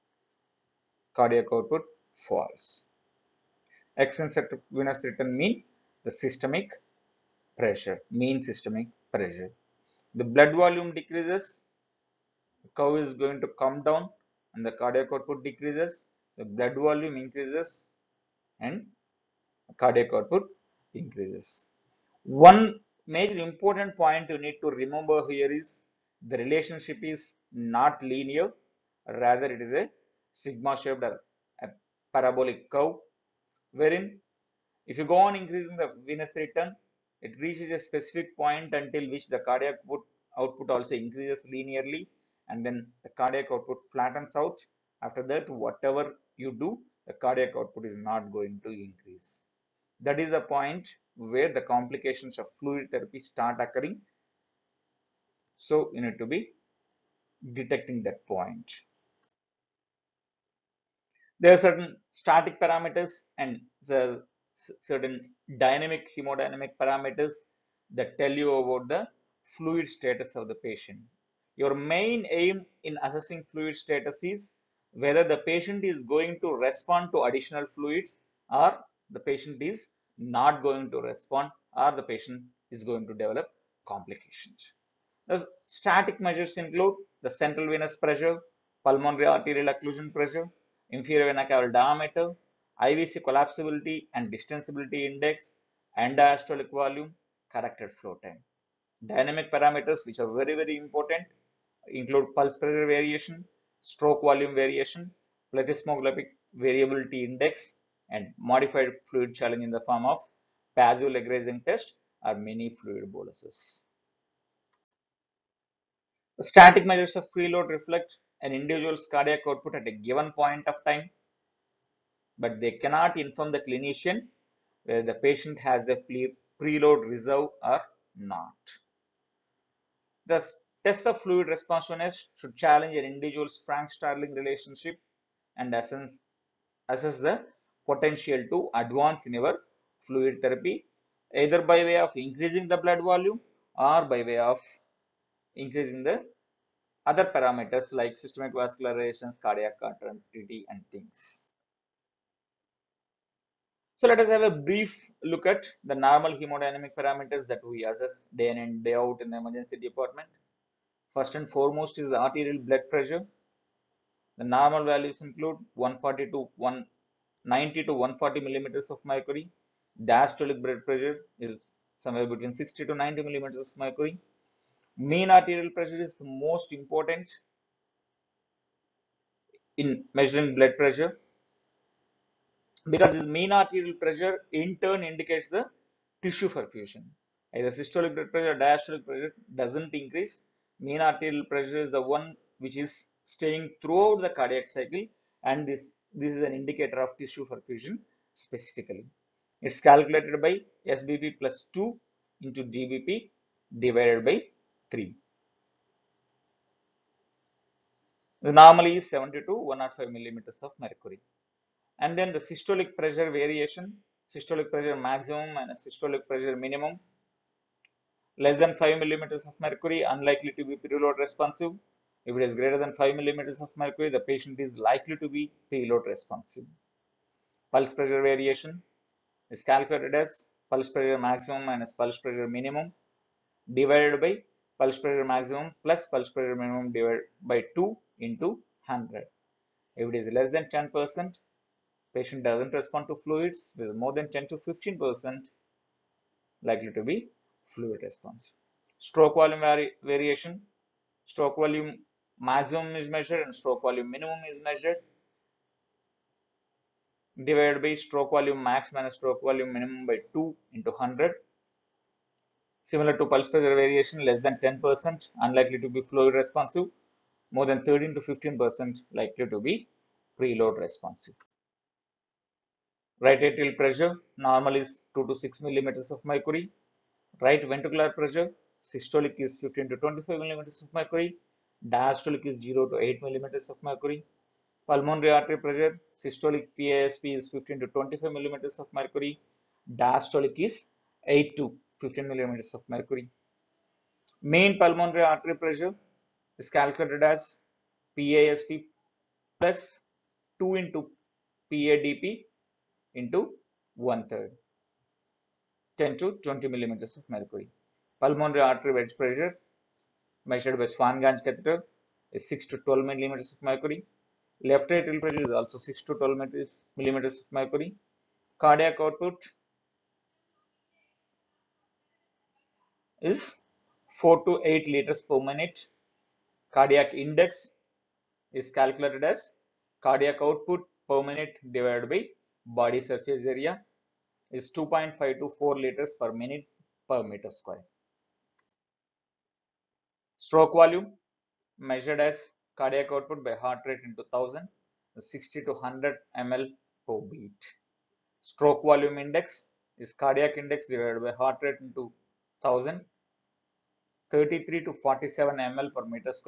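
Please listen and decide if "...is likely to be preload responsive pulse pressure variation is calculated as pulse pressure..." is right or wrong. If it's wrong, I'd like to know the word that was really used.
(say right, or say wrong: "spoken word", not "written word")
right.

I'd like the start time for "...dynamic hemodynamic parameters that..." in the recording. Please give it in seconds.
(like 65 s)
65 s.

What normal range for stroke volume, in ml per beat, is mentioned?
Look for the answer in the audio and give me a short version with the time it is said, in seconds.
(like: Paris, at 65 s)
60 to 100, at 345 s.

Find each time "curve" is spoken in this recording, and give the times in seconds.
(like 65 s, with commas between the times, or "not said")
12 s, 32 s.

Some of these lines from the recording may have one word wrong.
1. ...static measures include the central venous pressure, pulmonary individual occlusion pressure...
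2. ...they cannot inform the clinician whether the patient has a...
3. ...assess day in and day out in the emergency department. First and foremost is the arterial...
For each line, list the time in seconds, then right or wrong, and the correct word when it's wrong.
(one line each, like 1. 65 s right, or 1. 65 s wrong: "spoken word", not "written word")
1. 85 s wrong: "arterial", not "individual"
2. 122 s right
3. 157 s right.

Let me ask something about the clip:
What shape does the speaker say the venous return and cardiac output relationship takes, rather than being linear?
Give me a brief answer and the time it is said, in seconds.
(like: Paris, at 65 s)
Sigma shaped, at 30 s.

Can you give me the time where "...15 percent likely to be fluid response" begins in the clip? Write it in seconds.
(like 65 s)
244 s.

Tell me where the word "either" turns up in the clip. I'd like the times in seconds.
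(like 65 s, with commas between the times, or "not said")
141 s, 187 s.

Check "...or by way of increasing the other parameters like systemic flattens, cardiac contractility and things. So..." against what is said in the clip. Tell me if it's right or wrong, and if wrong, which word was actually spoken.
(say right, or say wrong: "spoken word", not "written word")
wrong: "vascularizations", not "flattens".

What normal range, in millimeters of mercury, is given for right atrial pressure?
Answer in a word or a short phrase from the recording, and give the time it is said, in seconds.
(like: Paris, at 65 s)
2 to 6, at 275 s.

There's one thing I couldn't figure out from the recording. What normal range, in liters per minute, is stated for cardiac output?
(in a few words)
4 to 8.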